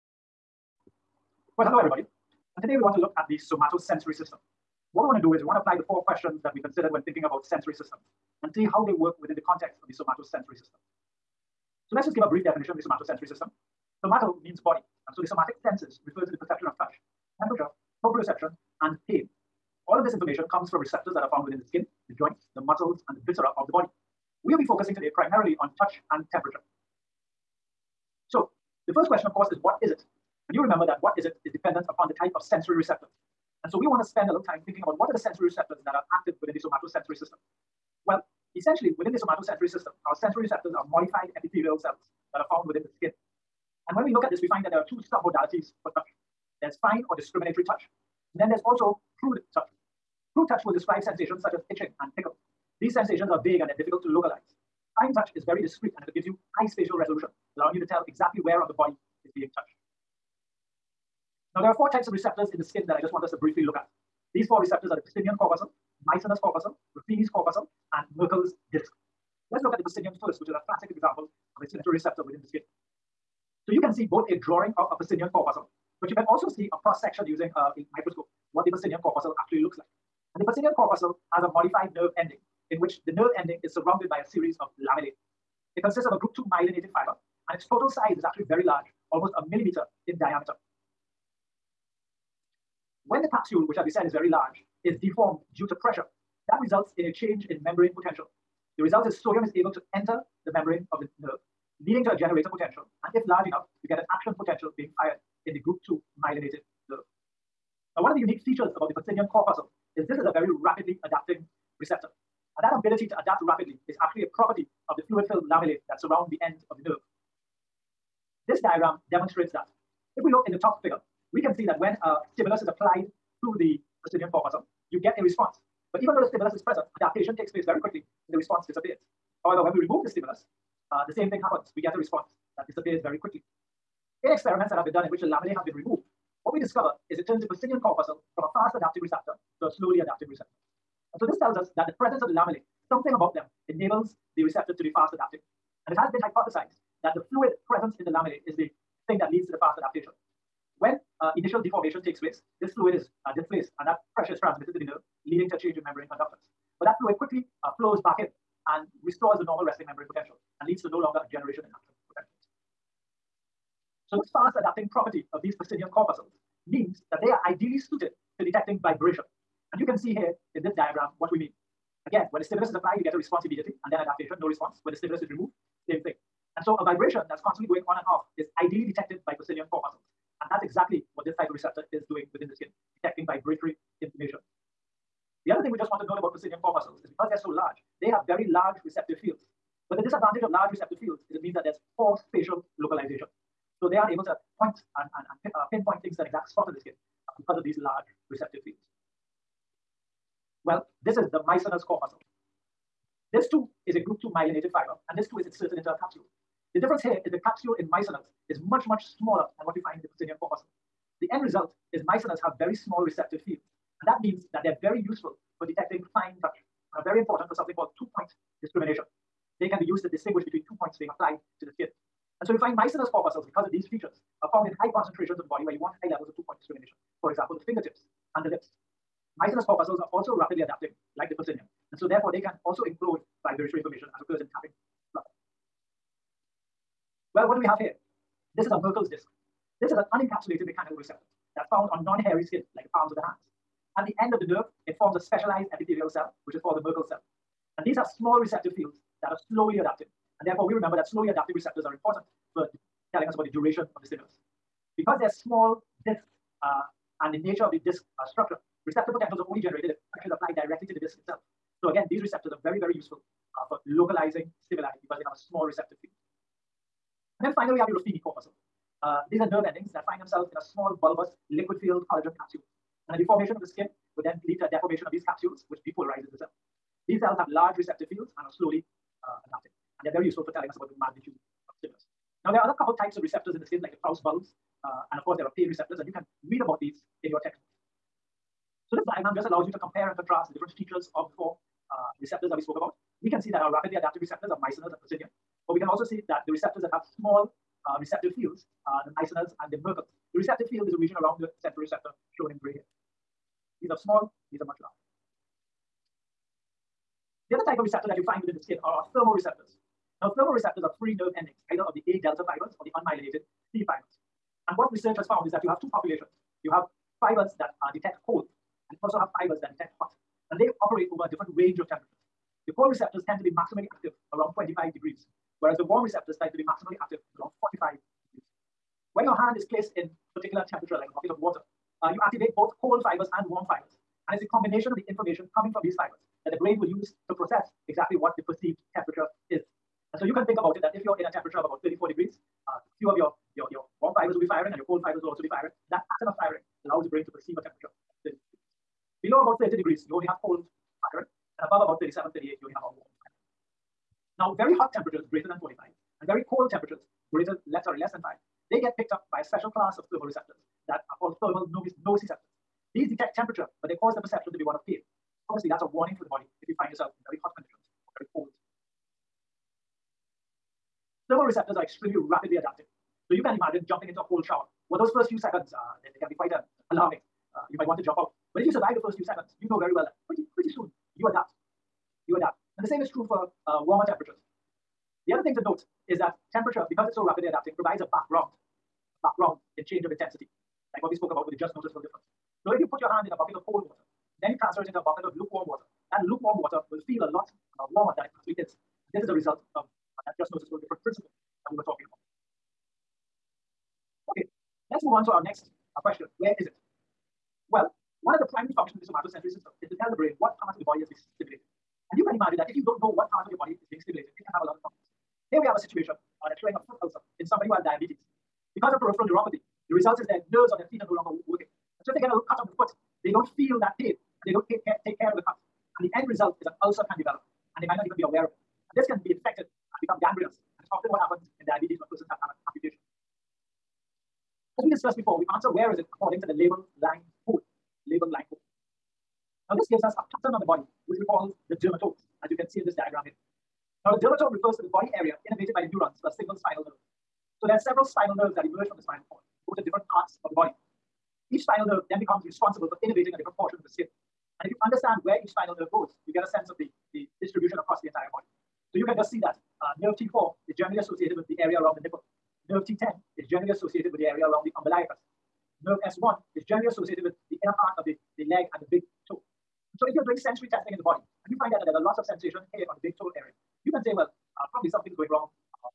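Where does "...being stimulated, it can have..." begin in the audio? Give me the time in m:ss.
6:53.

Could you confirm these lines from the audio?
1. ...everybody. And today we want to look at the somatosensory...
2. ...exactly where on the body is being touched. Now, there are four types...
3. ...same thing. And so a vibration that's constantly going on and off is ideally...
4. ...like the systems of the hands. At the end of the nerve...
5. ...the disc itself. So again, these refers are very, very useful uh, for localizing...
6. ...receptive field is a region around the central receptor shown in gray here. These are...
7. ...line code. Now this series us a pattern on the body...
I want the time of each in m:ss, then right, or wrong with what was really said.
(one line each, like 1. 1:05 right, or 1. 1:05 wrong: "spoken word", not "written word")
1. 0:01 right
2. 0:58 right
3. 2:55 right
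4. 4:02 wrong: "palms", not "systems"
5. 4:20 wrong: "receptors", not "refers"
6. 5:00 right
7. 7:18 wrong: "gives", not "series".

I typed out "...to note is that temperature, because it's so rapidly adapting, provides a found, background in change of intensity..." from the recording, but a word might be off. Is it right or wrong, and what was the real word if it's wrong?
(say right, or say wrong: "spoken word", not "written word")
wrong: "background", not "found".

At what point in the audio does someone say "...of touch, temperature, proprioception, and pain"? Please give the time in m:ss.
0:16.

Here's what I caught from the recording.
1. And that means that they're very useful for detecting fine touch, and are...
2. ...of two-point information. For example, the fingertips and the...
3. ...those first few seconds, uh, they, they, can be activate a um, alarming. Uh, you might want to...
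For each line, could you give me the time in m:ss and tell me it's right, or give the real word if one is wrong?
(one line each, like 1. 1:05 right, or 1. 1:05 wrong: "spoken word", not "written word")
1. 3:34 right
2. 3:46 wrong: "discrimination", not "information"
3. 6:14 wrong: "quite", not "activate".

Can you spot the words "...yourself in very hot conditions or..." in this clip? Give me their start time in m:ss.
6:06.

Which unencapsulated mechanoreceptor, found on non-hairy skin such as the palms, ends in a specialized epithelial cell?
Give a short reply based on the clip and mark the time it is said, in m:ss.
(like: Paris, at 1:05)
Merkel's disk, at 3:58.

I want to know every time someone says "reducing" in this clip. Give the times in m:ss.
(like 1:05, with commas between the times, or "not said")
not said.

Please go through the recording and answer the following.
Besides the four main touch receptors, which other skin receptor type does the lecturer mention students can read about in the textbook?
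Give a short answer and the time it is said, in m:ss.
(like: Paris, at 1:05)
Krause bulbs, at 4:44.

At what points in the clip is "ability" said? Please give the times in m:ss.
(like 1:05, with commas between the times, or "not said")
1:52.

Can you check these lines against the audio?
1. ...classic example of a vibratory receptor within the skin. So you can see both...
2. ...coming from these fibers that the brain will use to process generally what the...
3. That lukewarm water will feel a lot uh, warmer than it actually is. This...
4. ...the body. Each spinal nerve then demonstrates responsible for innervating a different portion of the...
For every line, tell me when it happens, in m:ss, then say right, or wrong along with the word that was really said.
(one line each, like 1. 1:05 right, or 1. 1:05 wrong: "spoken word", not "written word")
1. 1:10 wrong: "sensory", not "vibratory"
2. 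5:35 wrong: "exactly", not "generally"
3. 6:36 right
4. 7:30 wrong: "becomes", not "demonstrates".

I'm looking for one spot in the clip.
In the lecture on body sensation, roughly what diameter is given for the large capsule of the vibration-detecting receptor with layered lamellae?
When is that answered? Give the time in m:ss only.
1:29.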